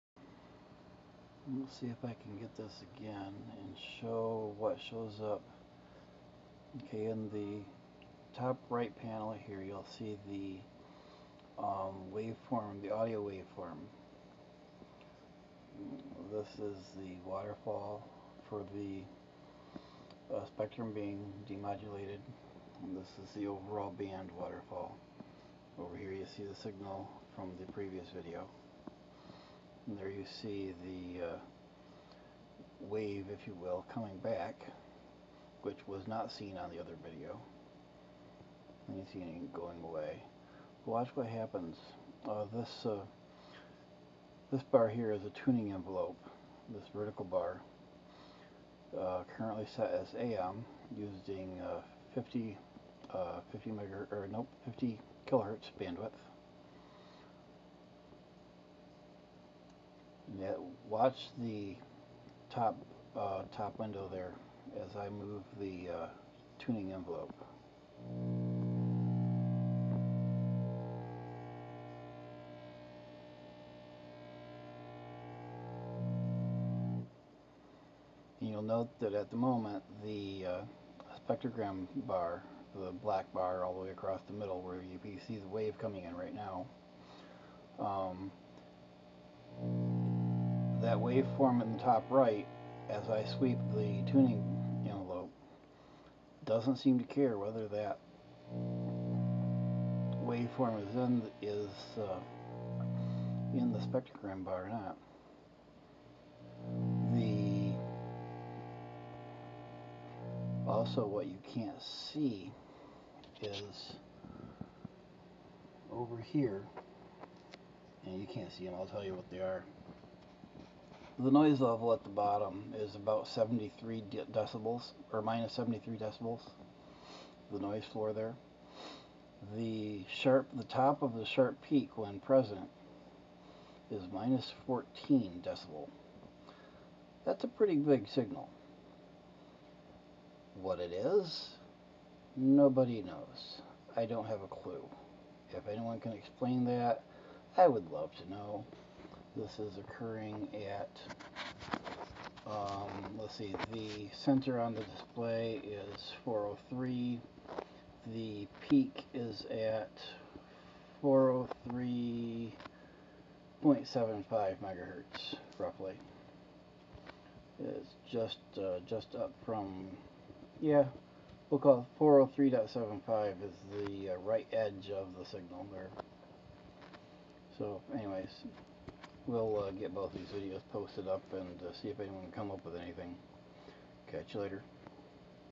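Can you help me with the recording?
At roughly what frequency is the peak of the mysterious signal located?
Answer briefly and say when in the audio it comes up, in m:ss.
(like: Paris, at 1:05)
403.75 megahertz, at 2:41.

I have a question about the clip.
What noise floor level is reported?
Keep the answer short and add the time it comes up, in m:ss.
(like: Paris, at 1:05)
-73 decibels, at 2:05.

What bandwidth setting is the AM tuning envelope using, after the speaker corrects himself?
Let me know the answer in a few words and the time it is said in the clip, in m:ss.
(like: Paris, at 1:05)
50 kilohertz, at 0:54.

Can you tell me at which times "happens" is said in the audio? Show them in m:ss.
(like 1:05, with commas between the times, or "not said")
0:41.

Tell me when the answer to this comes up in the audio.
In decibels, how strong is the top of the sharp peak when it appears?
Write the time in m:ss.
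2:14.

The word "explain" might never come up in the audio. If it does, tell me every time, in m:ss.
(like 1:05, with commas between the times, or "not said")
2:26.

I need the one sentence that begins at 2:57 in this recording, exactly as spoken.
So anyways, we'll uh, get both these videos posted up and uh, see if anyone can come up with anything.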